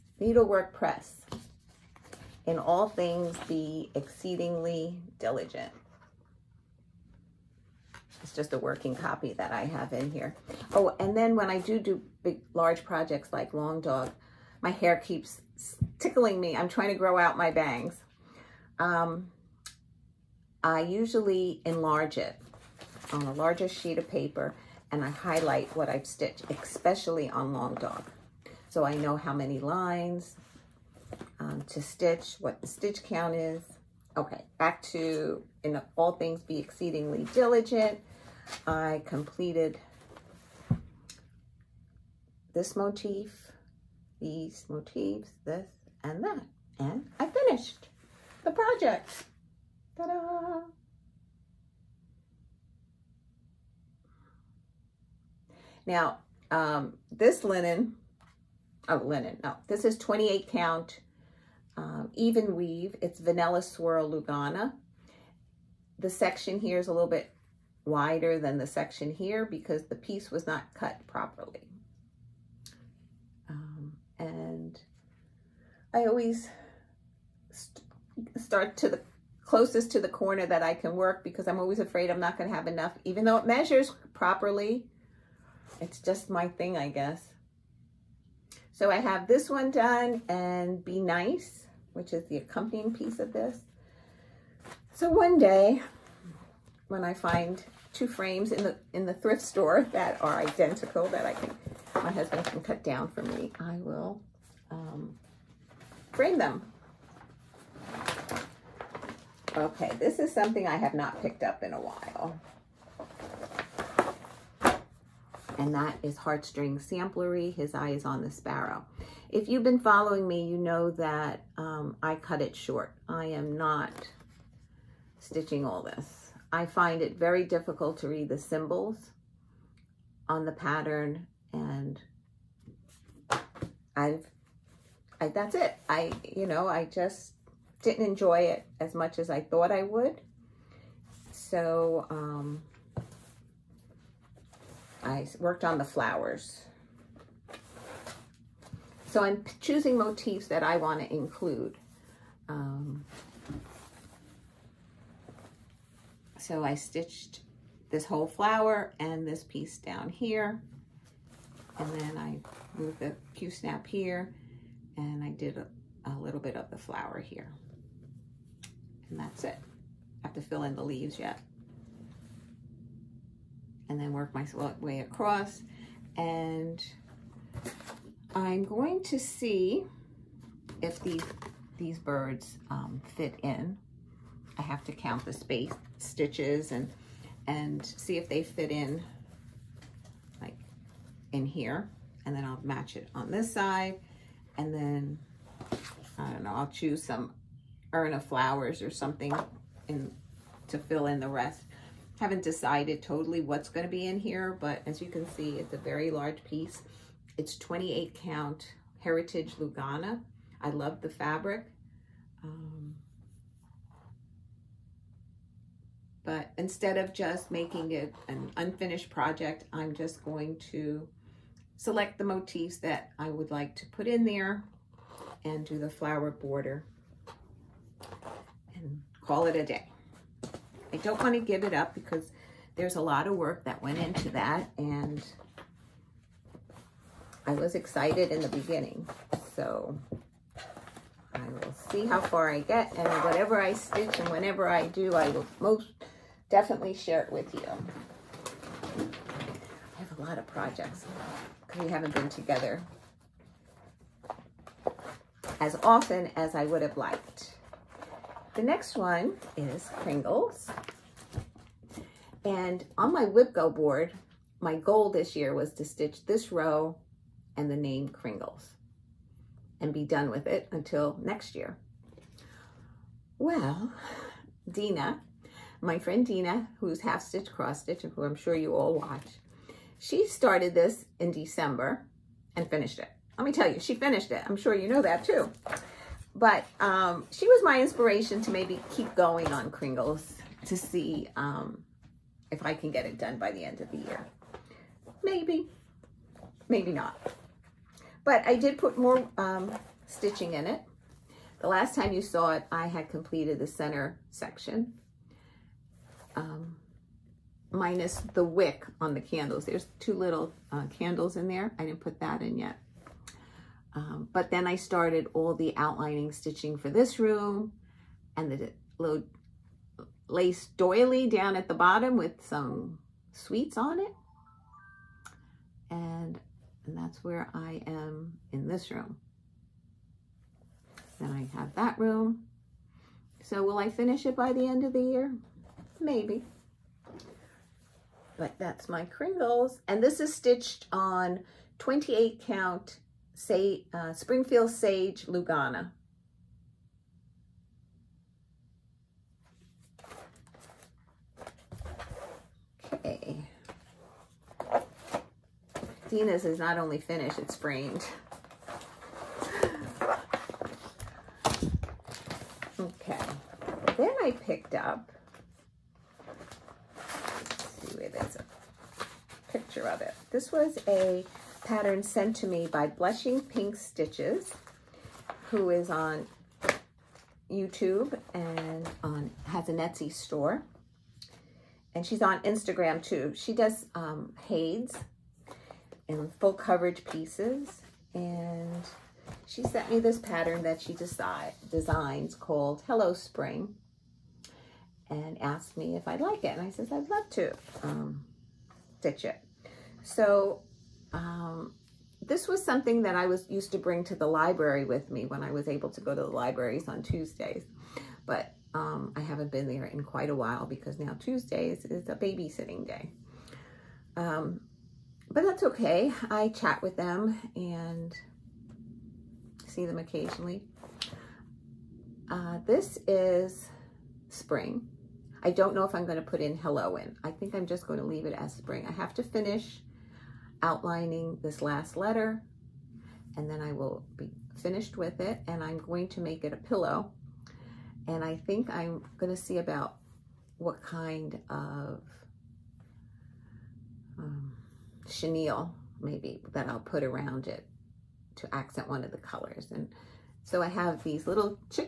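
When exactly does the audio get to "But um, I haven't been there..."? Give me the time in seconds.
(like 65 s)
408 s.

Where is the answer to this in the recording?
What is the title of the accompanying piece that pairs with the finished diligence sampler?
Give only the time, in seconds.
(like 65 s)
90 s.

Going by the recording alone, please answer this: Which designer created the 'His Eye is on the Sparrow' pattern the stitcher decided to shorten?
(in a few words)
Heartstring Samplery.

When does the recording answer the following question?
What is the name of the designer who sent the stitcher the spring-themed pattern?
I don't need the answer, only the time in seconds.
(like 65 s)
372 s.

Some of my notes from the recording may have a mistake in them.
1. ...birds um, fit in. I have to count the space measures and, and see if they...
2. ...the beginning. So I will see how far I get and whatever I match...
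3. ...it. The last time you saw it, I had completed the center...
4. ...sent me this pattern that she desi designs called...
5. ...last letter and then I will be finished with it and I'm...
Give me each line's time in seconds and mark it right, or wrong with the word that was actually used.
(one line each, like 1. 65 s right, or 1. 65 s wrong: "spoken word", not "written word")
1. 181 s wrong: "stitches", not "measures"
2. 238 s wrong: "stitch", not "match"
3. 300 s right
4. 389 s right
5. 431 s right.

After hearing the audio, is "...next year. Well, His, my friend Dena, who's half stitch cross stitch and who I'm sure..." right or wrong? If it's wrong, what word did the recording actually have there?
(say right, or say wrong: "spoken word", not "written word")
wrong: "Dena", not "His".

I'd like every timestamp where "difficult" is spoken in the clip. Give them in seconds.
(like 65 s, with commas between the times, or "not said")
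127 s.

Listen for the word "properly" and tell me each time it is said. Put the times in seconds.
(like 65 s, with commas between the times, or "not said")
71 s, 84 s.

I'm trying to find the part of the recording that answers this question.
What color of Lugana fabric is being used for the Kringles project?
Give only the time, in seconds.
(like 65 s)
344 s.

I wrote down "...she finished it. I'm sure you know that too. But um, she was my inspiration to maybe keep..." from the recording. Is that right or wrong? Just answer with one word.
right.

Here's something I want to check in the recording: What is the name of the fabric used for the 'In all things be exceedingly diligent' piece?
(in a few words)
Vanilla Swirl Lugana.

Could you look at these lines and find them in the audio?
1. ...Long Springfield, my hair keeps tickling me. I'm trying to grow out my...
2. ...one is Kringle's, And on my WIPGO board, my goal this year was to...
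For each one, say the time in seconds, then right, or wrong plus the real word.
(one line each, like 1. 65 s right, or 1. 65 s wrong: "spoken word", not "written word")
1. 13 s wrong: "Dog", not "Springfield"
2. 258 s right.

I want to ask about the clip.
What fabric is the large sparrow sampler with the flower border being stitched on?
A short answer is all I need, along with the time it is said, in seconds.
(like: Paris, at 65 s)
28 count Heritage Lugana, at 207 s.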